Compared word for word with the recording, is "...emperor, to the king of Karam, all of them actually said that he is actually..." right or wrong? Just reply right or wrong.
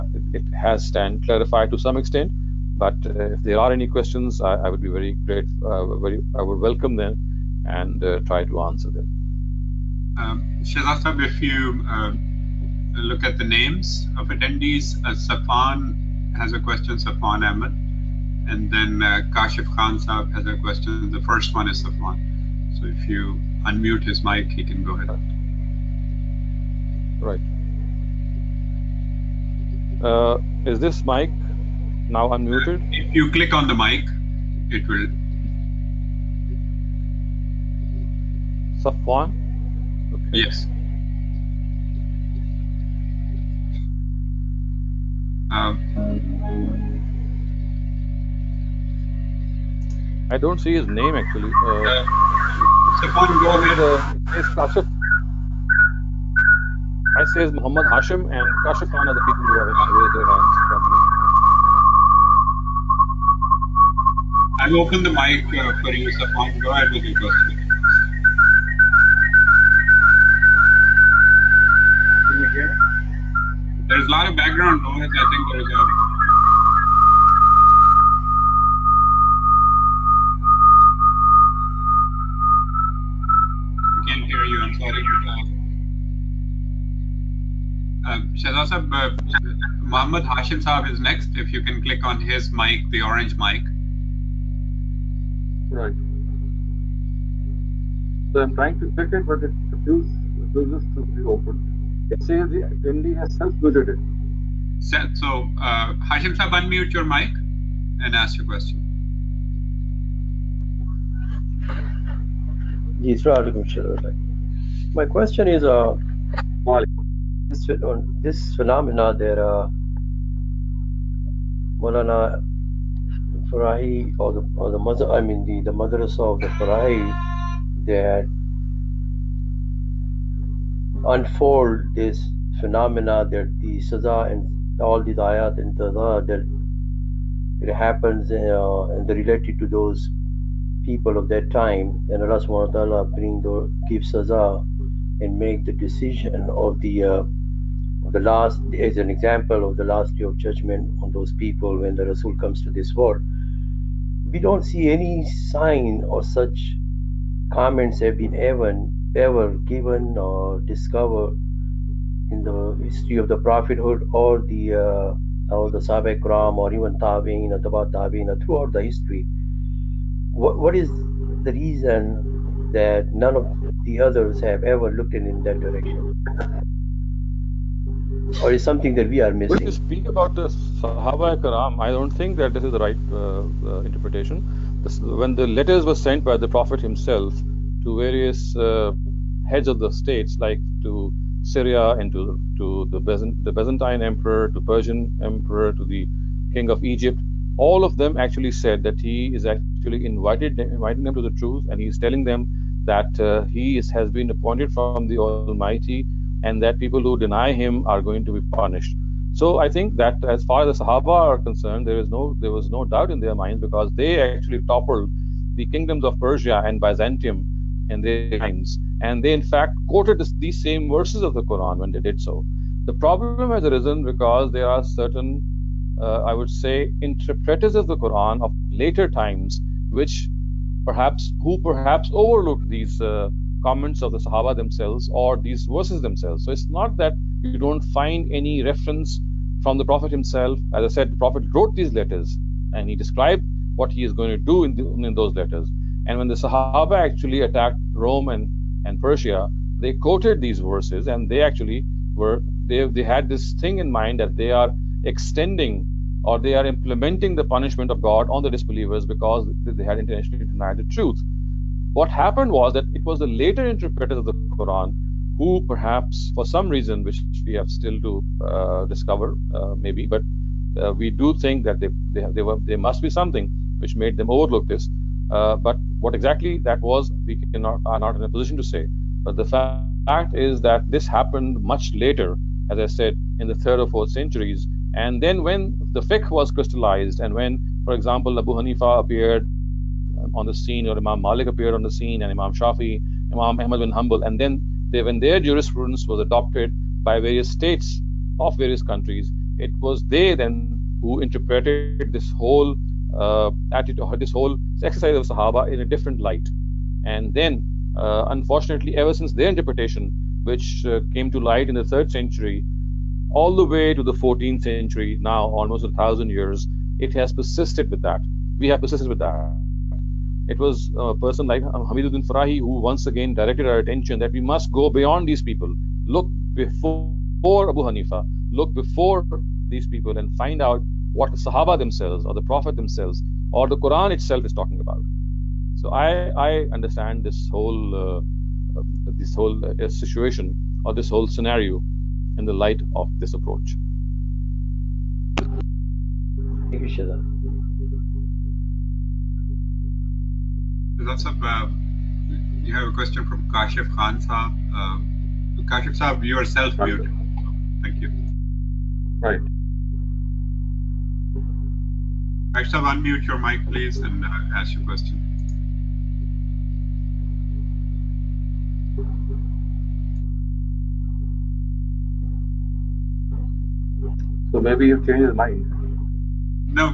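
wrong.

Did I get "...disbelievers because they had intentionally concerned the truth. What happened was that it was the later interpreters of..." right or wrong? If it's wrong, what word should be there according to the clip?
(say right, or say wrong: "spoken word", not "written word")
wrong: "denied", not "concerned".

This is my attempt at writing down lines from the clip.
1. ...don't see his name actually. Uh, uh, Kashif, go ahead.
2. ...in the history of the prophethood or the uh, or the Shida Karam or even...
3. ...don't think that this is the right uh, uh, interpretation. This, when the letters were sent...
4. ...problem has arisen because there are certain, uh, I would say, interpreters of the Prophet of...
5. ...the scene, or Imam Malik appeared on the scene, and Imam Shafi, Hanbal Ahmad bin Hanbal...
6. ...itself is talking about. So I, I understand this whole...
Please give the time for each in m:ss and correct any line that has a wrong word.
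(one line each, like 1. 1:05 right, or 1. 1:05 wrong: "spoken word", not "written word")
1. 0:50 wrong: "Stefan", not "Kashif"
2. 2:42 wrong: "Sahaba", not "Shida"
3. 3:01 right
4. 3:42 wrong: "Quran", not "Prophet"
5. 4:50 wrong: "Imam", not "Hanbal"
6. 5:34 right.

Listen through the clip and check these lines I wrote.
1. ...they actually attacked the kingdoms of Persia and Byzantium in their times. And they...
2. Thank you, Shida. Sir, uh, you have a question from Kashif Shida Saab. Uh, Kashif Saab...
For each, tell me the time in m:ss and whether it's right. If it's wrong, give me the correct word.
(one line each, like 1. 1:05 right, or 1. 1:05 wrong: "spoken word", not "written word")
1. 3:33 wrong: "toppled", not "attacked"
2. 5:45 wrong: "Khan", not "Shida".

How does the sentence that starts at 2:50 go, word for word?
What, what is the reason that none of the others have ever looked in, in that direction?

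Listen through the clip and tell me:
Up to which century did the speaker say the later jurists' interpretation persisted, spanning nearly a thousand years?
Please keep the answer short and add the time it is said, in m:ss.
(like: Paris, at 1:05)
14th century, at 5:14.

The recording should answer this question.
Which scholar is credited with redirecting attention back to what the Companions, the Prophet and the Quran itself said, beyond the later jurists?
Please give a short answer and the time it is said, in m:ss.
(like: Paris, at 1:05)
Hamiduddin Farahi, at 5:21.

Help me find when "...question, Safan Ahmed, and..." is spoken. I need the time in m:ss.
0:16.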